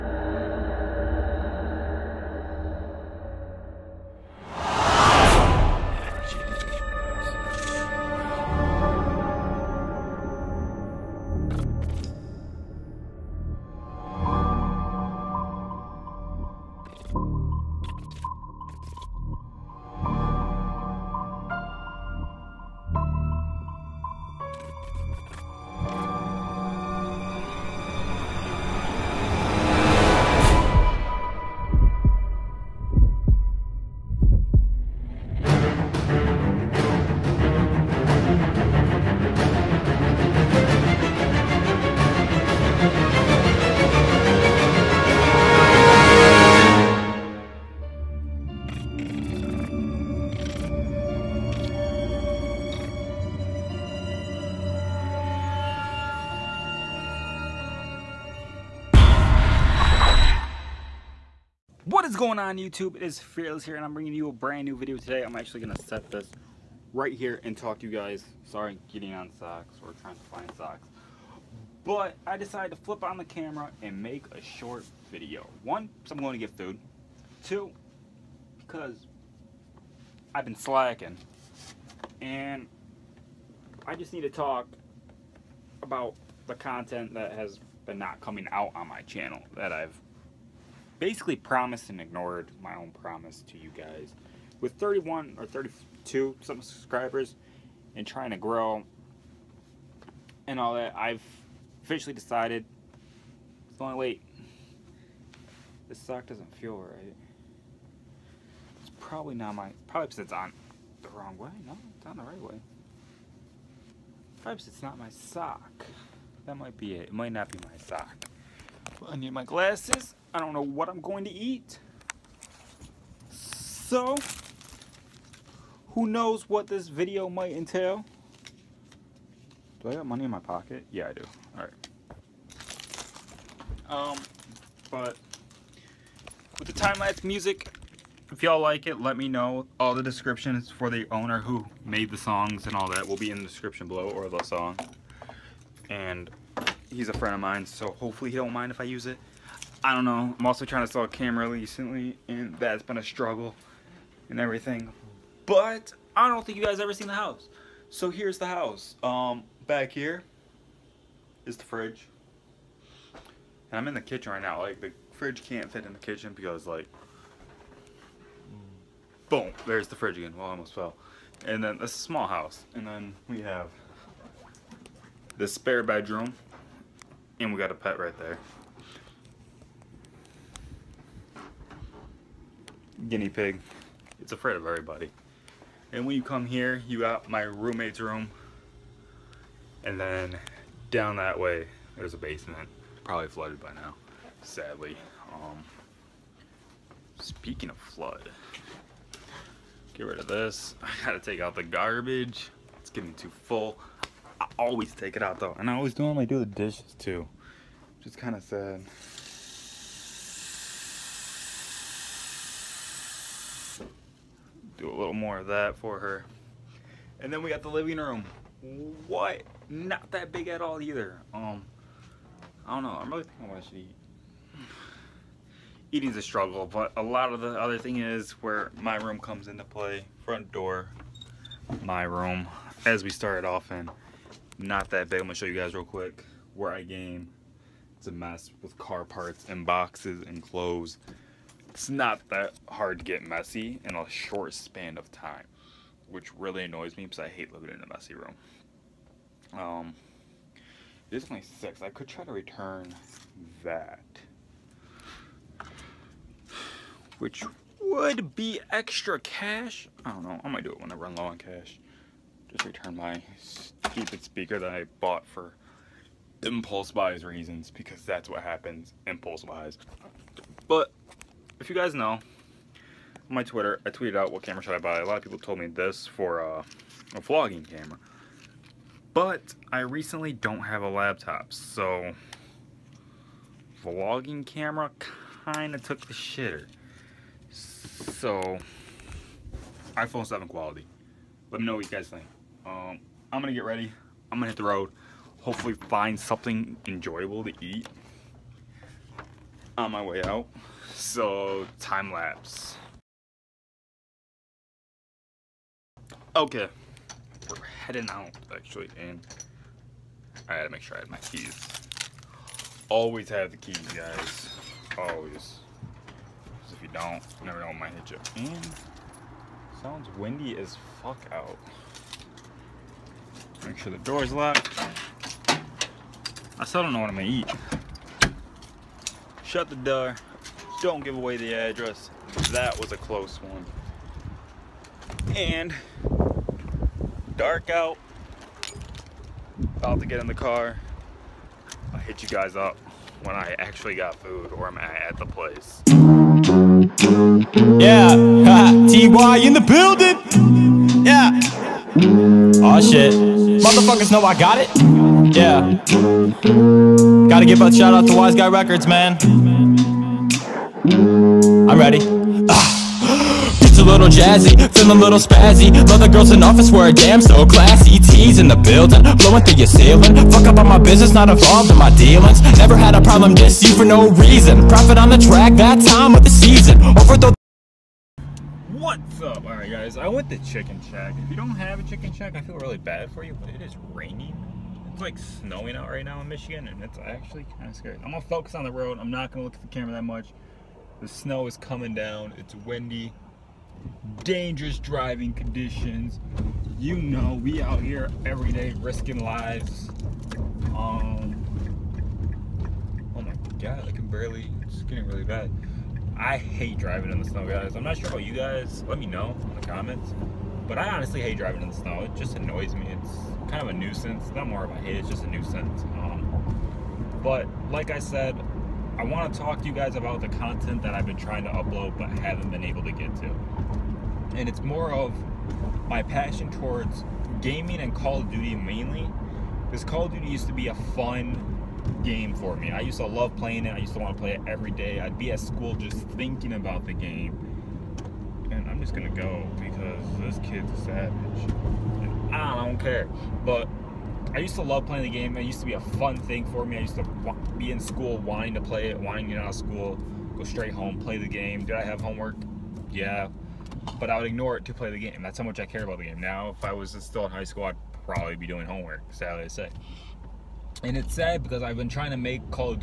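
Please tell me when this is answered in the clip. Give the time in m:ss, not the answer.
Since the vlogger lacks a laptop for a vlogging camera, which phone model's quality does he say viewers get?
4:49.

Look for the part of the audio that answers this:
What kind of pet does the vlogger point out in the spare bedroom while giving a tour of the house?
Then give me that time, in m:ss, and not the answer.
3:03.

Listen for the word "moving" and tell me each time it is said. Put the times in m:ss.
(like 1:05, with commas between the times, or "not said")
not said.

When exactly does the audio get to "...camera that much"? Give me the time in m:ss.
6:29.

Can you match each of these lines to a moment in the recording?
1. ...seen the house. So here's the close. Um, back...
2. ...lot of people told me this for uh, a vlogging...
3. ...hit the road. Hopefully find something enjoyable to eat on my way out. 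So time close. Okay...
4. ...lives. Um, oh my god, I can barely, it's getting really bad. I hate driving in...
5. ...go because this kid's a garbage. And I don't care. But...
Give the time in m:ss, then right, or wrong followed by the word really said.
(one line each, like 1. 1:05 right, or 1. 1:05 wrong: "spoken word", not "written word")
1. 2:36 wrong: "house", not "close"
2. 4:35 right
3. 4:54 wrong: "lapse", not "close"
4. 6:39 right
5. 7:19 wrong: "savage", not "garbage".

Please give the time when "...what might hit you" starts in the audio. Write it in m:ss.
5:17.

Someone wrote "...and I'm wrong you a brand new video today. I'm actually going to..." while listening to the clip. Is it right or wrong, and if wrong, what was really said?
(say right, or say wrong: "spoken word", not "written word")
wrong: "bringing", not "wrong".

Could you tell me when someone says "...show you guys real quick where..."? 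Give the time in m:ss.
3:55.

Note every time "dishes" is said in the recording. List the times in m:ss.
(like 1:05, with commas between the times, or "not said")
3:26.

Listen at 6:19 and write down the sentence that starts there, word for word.
Alright guys, I went to Chicken Shack.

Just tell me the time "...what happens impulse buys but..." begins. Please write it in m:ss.
4:28.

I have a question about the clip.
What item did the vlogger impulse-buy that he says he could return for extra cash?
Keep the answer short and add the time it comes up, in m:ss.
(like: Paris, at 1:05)
Speaker, at 4:24.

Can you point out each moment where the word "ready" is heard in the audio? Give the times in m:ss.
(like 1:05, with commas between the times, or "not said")
4:53, 6:01.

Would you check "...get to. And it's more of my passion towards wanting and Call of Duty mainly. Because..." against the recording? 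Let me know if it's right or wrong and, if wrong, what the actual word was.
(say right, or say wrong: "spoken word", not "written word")
wrong: "gaming", not "wanting".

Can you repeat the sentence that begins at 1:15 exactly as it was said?
One, because I'm going to get food.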